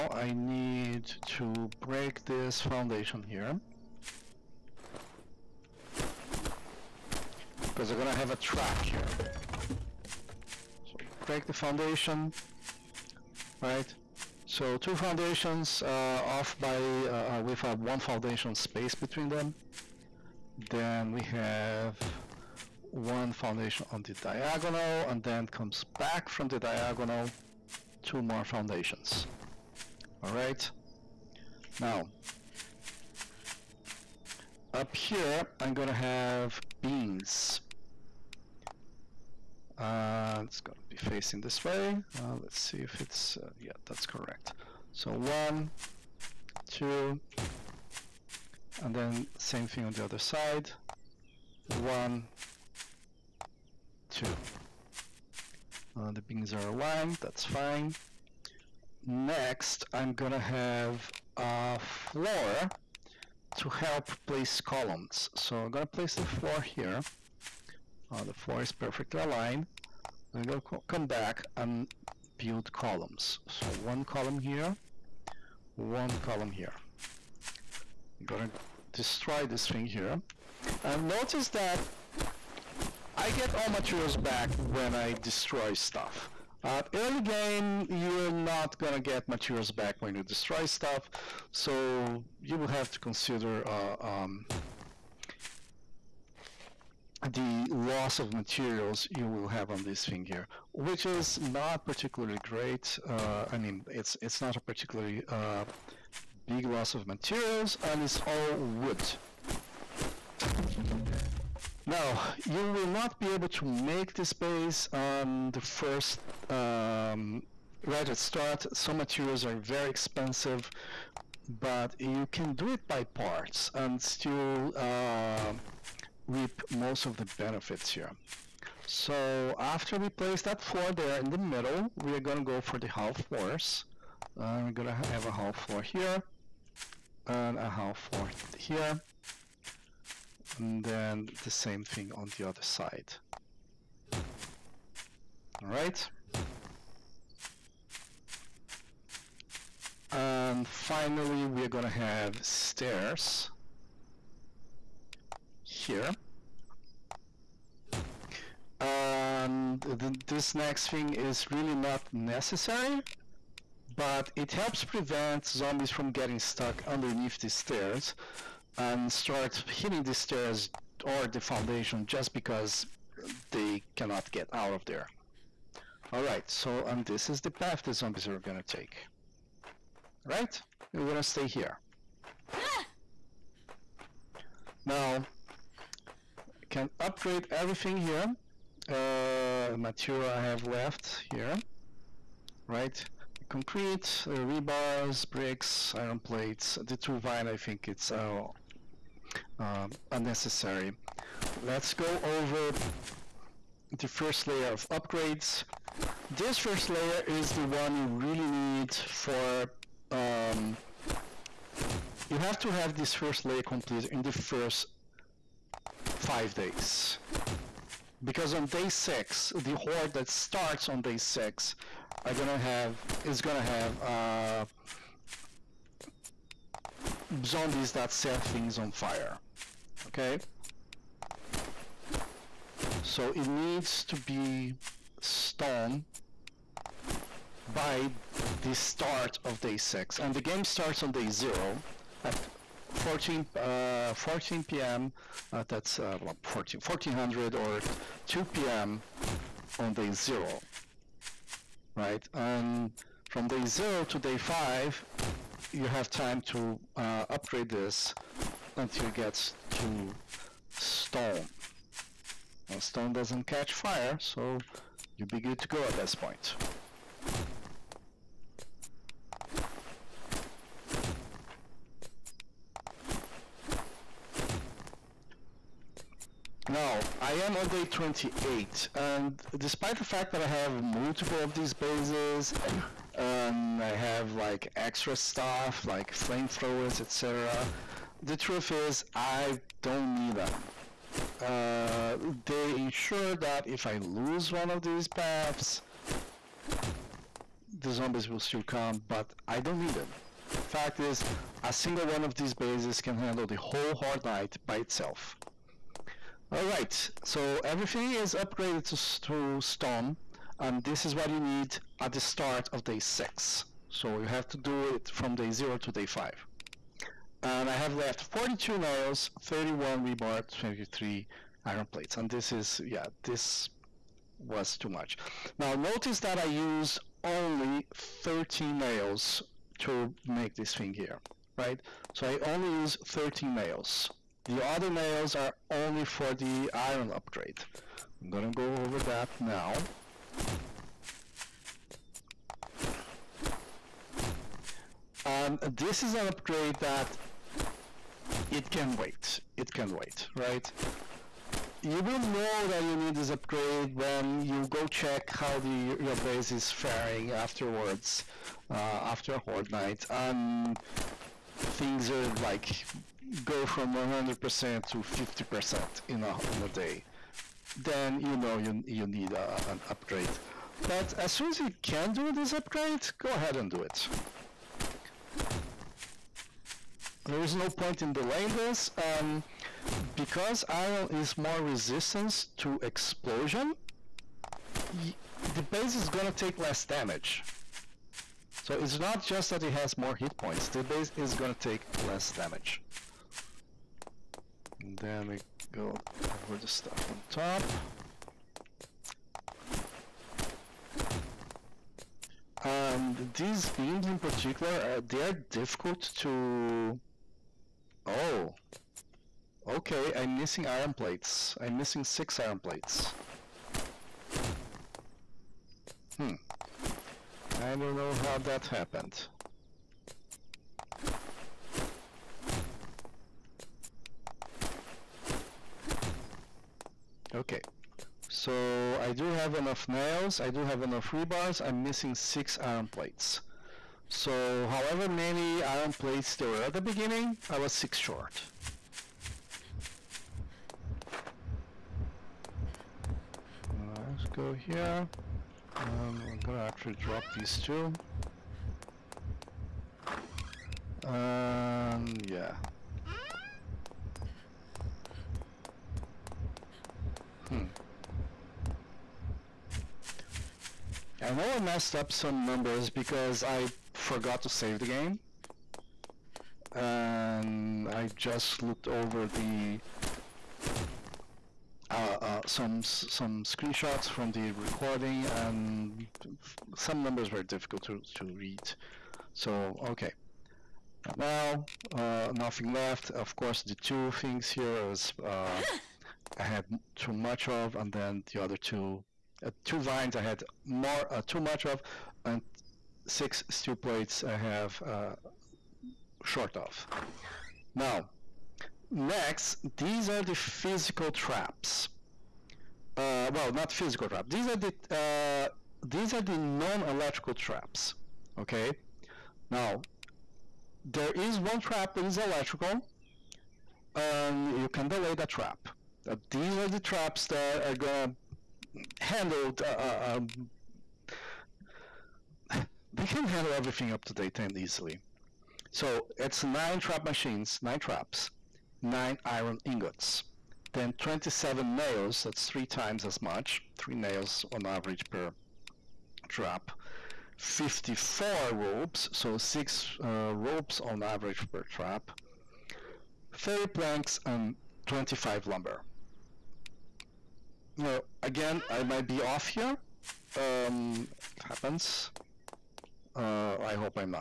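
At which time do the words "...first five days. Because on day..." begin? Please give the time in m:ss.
3:34.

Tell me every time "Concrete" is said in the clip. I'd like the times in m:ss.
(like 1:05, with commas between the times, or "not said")
3:13.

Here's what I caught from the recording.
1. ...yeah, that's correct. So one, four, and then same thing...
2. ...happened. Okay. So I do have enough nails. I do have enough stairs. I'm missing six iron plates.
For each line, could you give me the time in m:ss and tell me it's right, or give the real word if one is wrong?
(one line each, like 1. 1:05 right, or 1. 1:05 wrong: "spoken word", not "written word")
1. 0:43 wrong: "two", not "four"
2. 6:58 wrong: "rebars", not "stairs".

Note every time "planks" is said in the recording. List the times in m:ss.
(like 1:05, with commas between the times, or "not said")
9:03.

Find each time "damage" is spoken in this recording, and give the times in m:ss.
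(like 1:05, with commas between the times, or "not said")
6:26, 6:32.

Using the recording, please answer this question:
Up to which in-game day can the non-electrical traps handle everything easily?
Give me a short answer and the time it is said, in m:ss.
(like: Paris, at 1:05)
day 10, at 8:44.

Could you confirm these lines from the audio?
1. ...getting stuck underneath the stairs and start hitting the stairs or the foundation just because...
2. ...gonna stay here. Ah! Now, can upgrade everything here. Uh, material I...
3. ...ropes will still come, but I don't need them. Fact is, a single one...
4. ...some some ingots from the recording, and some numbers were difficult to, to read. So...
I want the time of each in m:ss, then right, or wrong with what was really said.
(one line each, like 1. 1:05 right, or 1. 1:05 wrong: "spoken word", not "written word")
1. 2:46 right
2. 3:01 right
3. 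4:57 wrong: "zombies", not "ropes"
4. 7:52 wrong: "screenshots", not "ingots".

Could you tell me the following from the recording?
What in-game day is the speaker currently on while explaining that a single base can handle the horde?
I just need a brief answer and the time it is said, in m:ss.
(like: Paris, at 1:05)
day 28, at 4:37.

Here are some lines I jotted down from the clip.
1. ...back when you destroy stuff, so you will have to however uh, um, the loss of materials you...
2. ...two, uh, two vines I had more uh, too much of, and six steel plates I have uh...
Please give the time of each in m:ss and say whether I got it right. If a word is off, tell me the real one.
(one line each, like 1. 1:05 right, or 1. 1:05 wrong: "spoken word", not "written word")
1. 1:29 wrong: "consider", not "however"
2. 8:08 right.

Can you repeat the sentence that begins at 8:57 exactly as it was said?
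54 ropes, so six uh, ropes on average per trap.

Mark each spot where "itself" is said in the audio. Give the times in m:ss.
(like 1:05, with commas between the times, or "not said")
5:04.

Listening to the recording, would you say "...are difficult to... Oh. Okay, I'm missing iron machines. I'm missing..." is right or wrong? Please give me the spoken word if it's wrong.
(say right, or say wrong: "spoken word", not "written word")
wrong: "plates", not "machines".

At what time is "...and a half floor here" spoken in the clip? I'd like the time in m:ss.
2:17.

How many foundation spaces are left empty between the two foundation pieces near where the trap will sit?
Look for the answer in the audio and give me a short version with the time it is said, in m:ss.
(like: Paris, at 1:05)
1, at 0:17.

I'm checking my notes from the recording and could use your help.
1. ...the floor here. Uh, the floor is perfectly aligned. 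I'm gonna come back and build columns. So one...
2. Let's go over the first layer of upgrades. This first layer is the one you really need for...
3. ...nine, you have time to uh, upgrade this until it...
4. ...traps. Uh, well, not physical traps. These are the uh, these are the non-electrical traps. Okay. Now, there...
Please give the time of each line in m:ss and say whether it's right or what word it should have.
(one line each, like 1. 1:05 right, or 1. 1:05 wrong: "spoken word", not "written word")
1. 1:06 right
2. 3:21 right
3. 4:14 wrong: "five", not "nine"
4. 8:21 right.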